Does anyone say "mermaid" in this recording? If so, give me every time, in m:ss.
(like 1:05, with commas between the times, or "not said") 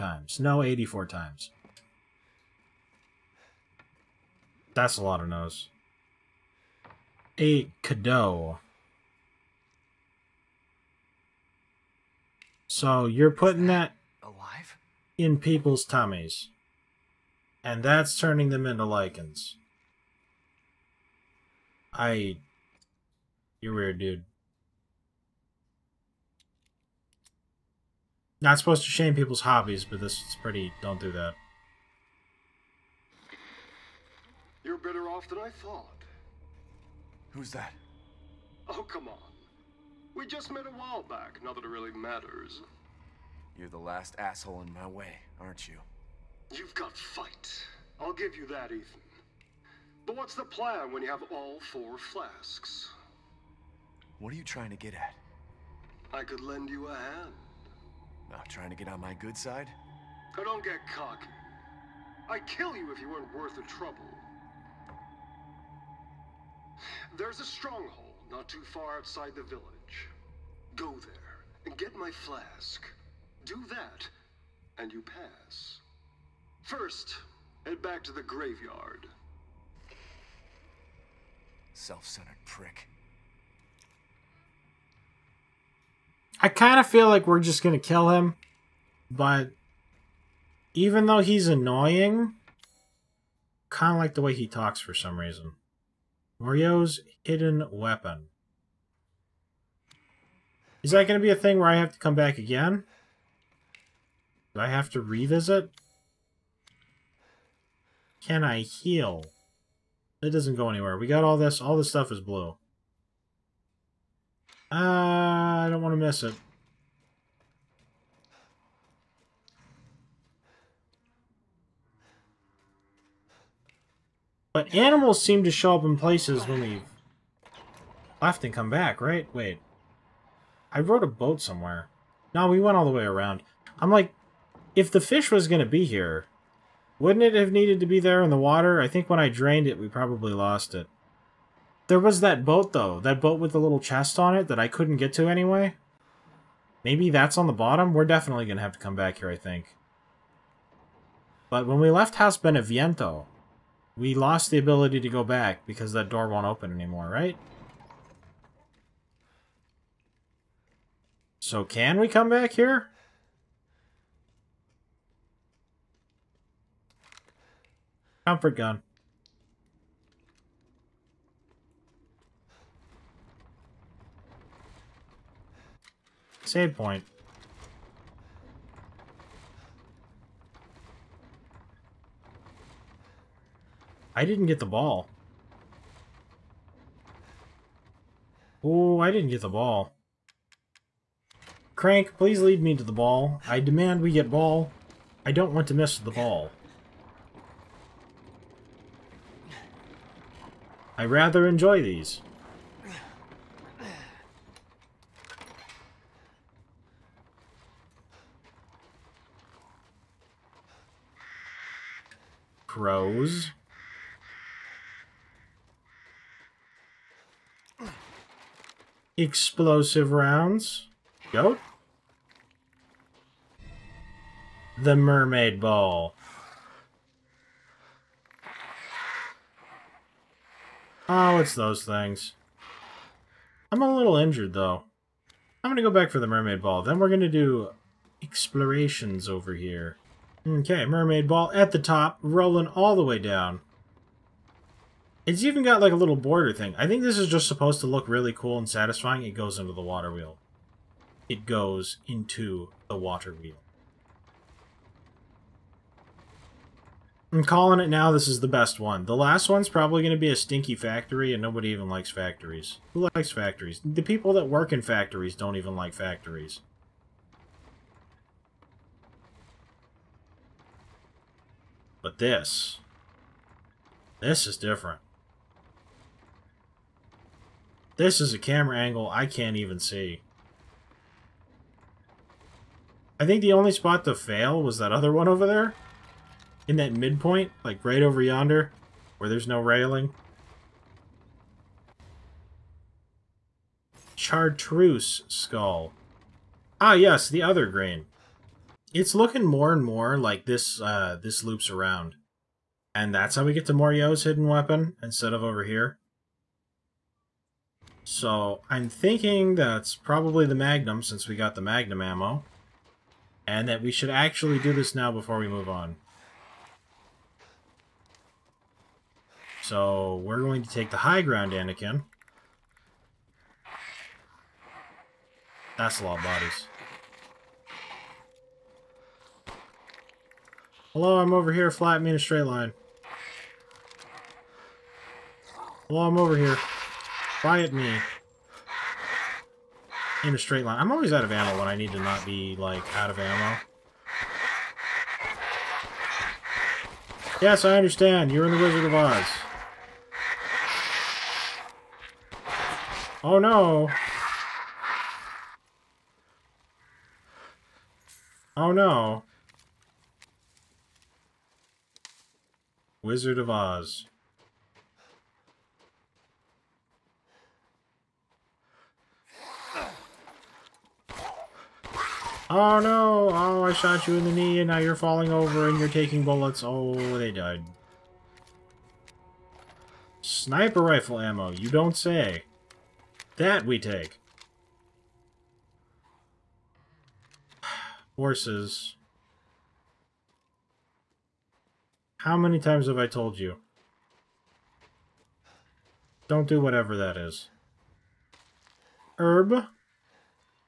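3:44, 3:56, 4:00.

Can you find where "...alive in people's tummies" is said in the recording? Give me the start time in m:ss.
0:14.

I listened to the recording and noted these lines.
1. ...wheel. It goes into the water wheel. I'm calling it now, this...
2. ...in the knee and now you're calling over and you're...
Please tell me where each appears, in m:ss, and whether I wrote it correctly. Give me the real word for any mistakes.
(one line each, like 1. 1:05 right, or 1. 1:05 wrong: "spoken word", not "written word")
1. 4:10 right
2. 6:14 wrong: "falling", not "calling".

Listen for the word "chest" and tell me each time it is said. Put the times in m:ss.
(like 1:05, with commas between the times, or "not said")
2:23.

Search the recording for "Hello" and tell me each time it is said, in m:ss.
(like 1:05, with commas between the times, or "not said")
5:30, 5:35.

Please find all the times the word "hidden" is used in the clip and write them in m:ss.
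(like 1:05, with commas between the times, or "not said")
1:37, 5:04.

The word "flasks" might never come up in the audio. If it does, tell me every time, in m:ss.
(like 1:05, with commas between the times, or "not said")
0:51, 1:12.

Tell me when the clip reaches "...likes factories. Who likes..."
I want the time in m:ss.
4:21.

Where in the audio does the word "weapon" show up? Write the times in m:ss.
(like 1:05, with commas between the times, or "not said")
1:37, 5:04.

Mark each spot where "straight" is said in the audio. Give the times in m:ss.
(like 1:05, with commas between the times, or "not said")
5:32, 5:40.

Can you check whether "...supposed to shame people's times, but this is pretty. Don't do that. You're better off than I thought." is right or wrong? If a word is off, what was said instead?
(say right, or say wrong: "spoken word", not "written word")
wrong: "hobbies", not "times".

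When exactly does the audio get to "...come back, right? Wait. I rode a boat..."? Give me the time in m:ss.
2:08.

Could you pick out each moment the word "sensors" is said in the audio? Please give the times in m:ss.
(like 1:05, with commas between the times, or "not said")
not said.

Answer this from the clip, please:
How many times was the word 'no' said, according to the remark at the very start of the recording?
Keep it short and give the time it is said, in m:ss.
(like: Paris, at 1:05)
84, at 0:00.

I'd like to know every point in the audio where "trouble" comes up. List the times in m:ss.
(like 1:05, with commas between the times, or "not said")
1:03.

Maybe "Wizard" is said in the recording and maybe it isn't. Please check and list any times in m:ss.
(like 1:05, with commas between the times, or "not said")
5:48, 6:03.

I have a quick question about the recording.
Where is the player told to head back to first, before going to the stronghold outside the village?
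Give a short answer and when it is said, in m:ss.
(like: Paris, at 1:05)
The graveyard, at 1:18.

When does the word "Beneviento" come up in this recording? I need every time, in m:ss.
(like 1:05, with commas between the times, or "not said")
2:32.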